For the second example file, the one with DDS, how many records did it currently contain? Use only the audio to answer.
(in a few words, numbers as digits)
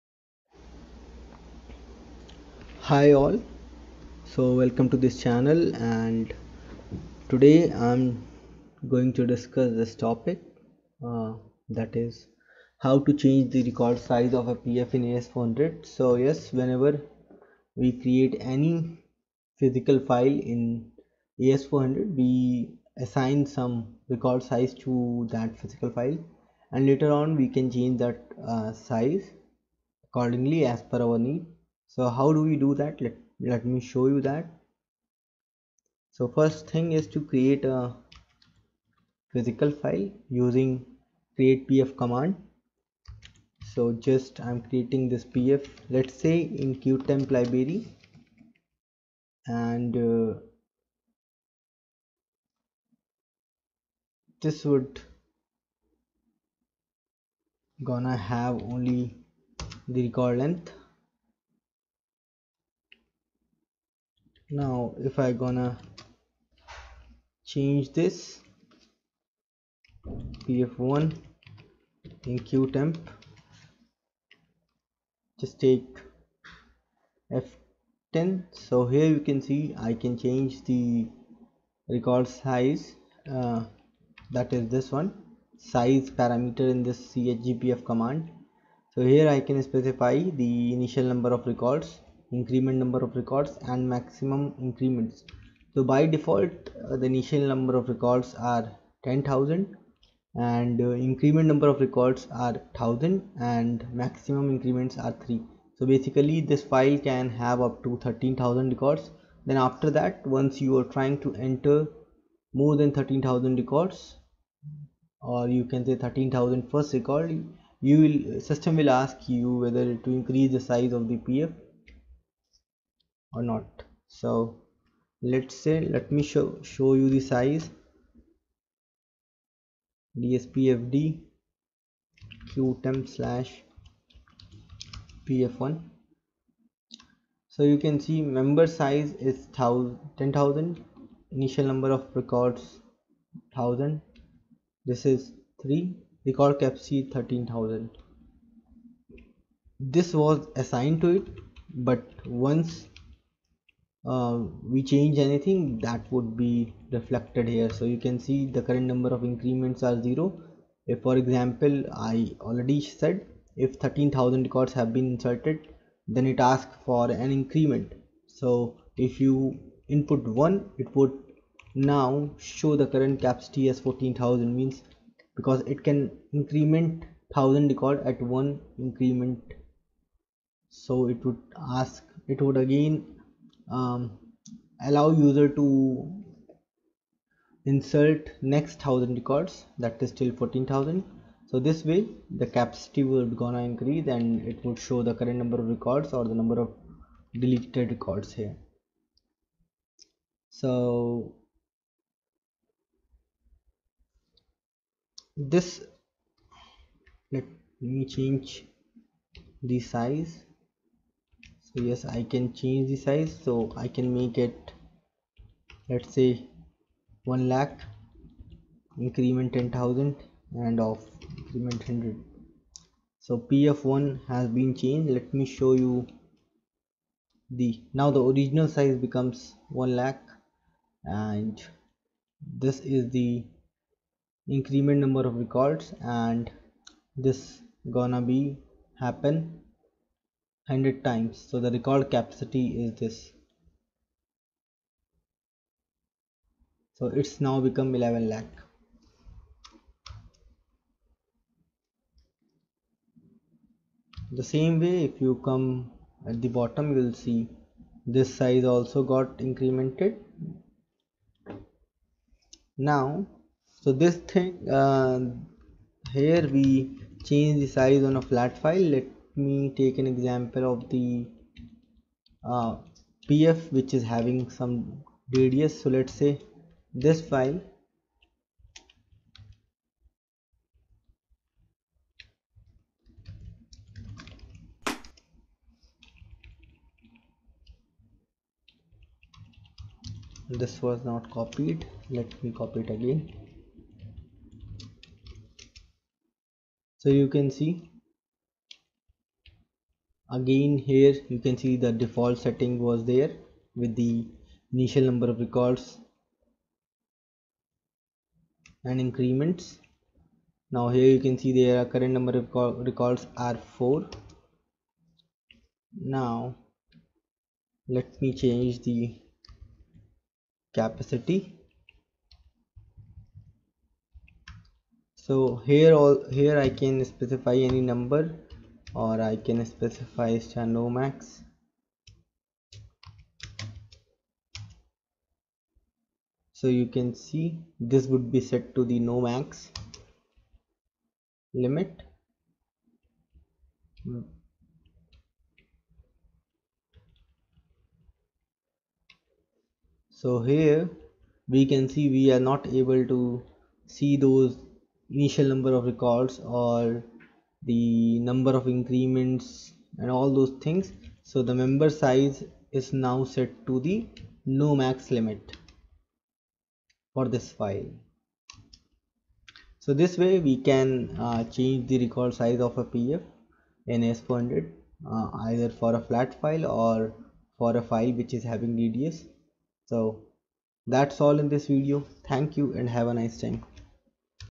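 4.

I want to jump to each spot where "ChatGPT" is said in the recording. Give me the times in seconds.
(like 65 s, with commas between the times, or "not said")
not said.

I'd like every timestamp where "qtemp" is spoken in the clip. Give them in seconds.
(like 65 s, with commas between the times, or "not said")
46 s, 72 s, 132 s.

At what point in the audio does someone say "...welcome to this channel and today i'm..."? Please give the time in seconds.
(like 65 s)
4 s.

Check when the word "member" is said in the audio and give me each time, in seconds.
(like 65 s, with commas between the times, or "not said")
138 s, 361 s.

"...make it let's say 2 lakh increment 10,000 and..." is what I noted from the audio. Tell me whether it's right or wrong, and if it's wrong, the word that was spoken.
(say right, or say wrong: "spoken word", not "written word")
wrong: "1", not "2".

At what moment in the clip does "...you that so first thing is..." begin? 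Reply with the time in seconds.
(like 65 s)
34 s.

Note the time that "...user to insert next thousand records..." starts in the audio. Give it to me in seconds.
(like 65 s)
185 s.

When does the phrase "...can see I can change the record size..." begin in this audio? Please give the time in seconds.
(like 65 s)
79 s.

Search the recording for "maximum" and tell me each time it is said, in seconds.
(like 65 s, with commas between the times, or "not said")
93 s, 104 s.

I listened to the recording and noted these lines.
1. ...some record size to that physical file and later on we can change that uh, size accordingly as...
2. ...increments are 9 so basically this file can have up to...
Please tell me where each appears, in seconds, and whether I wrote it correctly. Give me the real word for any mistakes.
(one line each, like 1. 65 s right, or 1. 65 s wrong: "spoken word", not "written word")
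1. 23 s right
2. 104 s wrong: "3", not "9".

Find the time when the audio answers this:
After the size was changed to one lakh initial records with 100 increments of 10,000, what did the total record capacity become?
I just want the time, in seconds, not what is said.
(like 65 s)
247 s.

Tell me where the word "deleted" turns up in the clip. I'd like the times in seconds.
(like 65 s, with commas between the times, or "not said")
197 s.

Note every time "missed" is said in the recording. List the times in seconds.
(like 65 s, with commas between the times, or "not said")
not said.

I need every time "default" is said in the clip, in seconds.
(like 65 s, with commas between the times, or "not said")
96 s, 302 s.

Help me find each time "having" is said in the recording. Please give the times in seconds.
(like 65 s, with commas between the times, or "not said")
274 s, 378 s.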